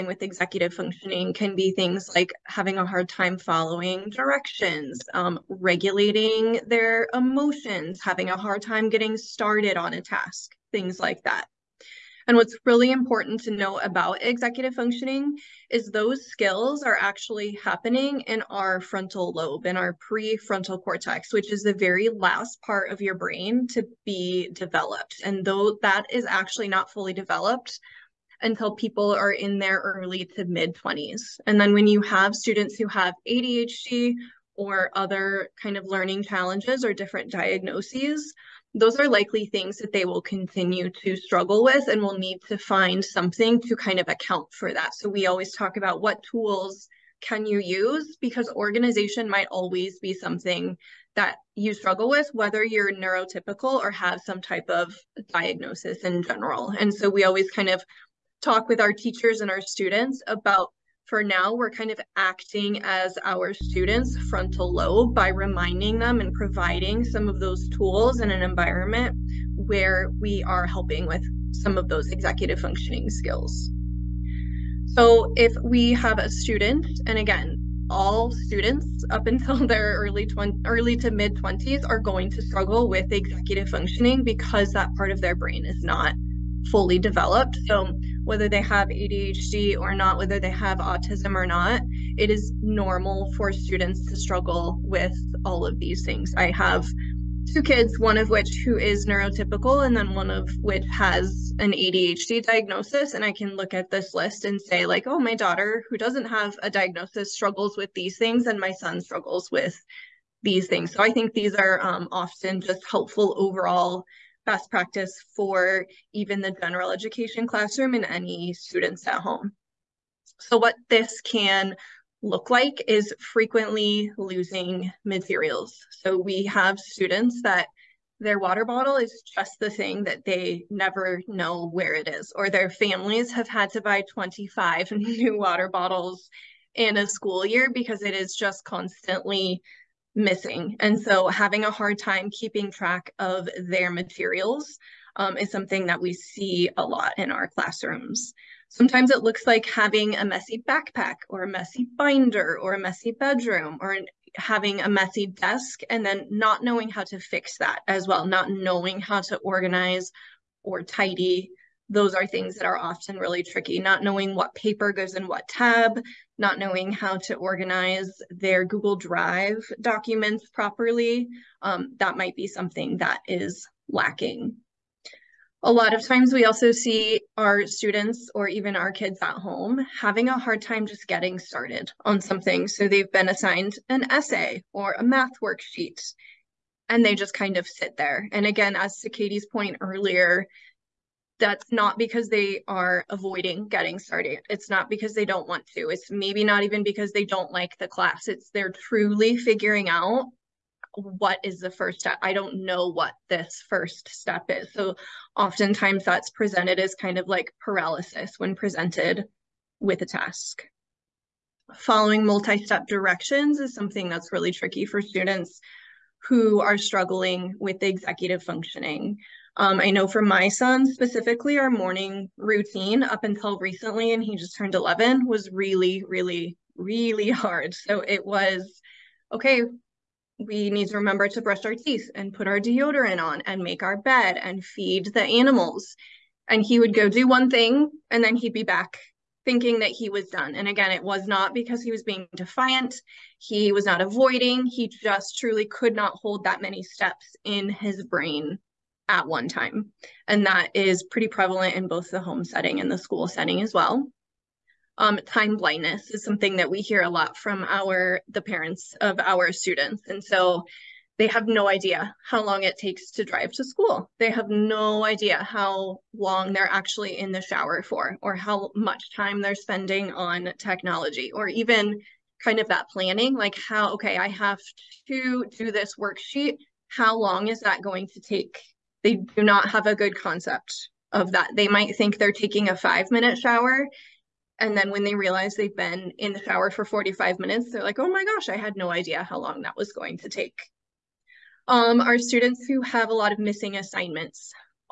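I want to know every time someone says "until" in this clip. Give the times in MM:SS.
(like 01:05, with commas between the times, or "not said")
00:28, 01:19, 03:43.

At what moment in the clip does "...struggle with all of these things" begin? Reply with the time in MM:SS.
01:34.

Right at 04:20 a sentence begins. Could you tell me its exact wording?
And so they have no idea how long it takes to drive to school.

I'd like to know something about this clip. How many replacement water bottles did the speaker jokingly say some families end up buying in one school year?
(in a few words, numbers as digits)
25.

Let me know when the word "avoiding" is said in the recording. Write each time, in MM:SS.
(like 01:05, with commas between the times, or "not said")
03:13, 04:04.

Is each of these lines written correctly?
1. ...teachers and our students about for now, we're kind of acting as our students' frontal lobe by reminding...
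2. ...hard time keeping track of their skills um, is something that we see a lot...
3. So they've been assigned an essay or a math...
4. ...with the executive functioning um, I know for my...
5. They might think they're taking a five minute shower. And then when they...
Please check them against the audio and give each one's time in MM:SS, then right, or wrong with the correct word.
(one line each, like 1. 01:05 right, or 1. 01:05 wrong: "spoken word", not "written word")
1. 00:58 right
2. 02:21 wrong: "materials", not "skills"
3. 03:02 right
4. 03:37 right
5. 04:41 right.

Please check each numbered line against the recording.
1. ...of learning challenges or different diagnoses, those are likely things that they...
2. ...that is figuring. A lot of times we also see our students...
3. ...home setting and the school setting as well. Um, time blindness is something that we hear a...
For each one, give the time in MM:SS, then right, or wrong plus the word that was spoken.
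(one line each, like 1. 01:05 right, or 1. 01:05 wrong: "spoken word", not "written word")
1. 00:35 right
2. 02:52 wrong: "lacking", not "figuring"
3. 04:12 right.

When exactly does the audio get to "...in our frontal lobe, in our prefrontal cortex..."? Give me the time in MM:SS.
00:18.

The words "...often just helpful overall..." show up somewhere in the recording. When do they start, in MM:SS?
01:52.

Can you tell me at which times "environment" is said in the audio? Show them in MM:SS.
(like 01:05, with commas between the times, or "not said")
01:08.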